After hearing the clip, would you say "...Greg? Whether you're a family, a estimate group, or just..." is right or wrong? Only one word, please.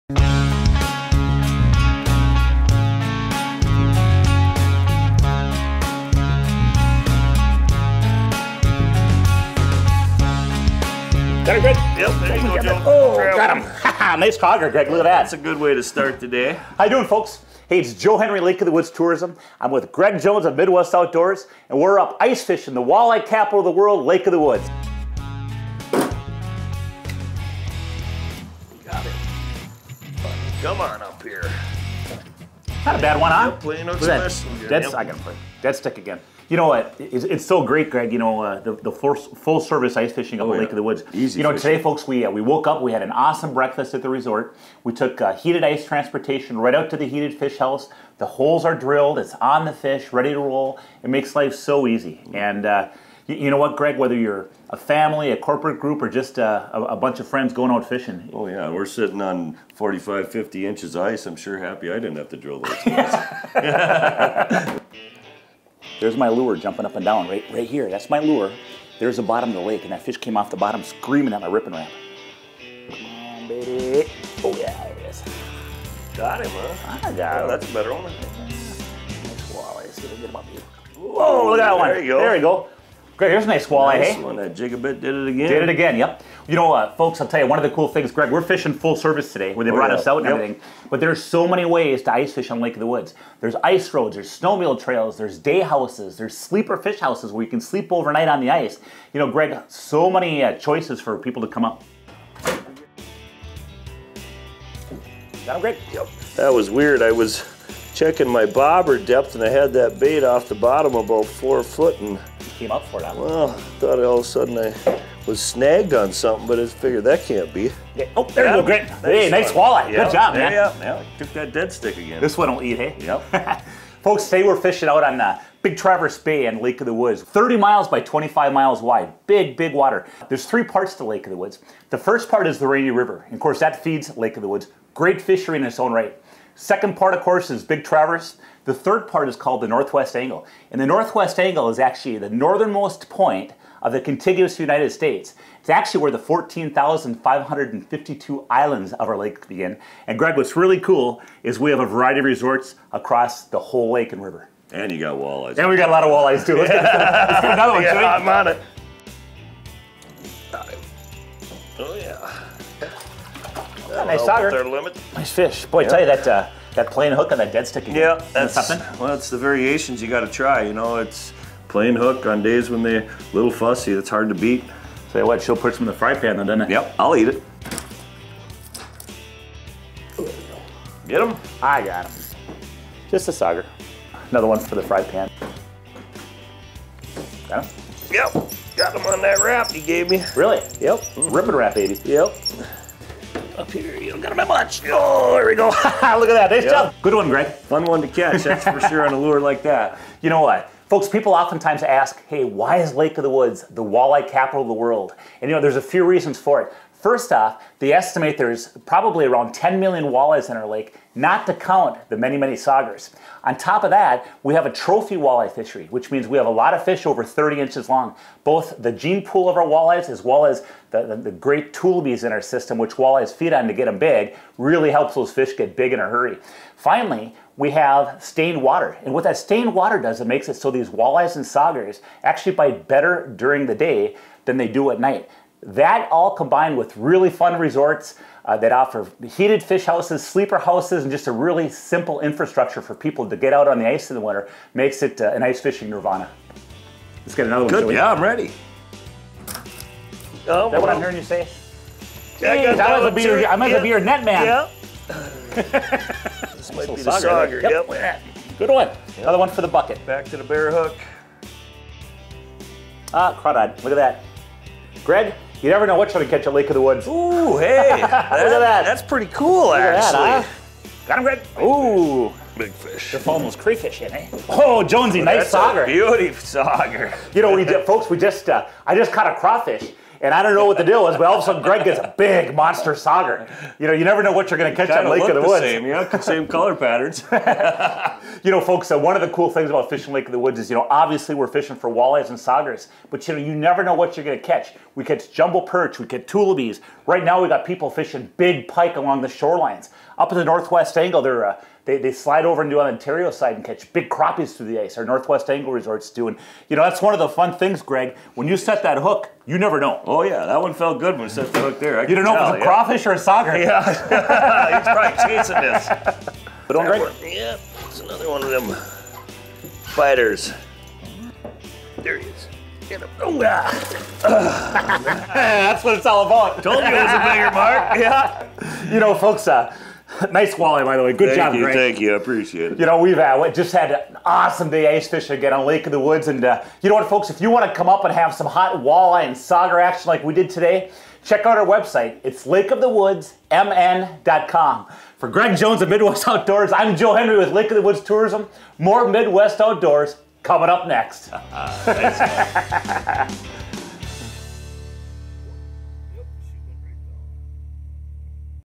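wrong.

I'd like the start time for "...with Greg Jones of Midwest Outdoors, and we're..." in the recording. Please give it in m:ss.
0:19.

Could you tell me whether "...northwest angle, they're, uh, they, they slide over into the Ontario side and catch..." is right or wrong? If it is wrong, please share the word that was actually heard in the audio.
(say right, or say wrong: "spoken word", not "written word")
right.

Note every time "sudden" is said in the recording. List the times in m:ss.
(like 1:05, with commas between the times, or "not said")
1:54, 4:41.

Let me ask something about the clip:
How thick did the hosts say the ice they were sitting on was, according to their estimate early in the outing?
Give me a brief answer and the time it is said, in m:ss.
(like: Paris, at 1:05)
45, 50 inches, at 0:59.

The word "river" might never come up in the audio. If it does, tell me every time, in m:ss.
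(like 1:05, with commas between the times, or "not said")
2:12, 2:34.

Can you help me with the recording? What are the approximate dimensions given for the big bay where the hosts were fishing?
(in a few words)
30 miles by 25 miles.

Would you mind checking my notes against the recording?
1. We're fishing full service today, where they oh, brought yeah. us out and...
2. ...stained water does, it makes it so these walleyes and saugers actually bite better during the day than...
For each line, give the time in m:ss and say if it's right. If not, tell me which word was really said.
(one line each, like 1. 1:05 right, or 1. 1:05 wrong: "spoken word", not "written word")
1. 1:28 right
2. 3:49 right.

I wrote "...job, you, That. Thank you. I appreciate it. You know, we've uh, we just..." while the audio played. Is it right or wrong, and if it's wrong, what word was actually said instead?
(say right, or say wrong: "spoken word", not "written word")
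wrong: "Greg", not "That".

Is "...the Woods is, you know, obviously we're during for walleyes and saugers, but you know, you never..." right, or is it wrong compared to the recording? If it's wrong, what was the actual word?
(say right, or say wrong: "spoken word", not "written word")
wrong: "fishing", not "during".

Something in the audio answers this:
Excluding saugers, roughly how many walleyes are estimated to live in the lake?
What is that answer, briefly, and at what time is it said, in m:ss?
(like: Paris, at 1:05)
10 million, at 3:29.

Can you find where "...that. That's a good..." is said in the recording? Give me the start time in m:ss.
0:15.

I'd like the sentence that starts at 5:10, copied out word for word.
Oh yeah, that one felt good when you set the hook there.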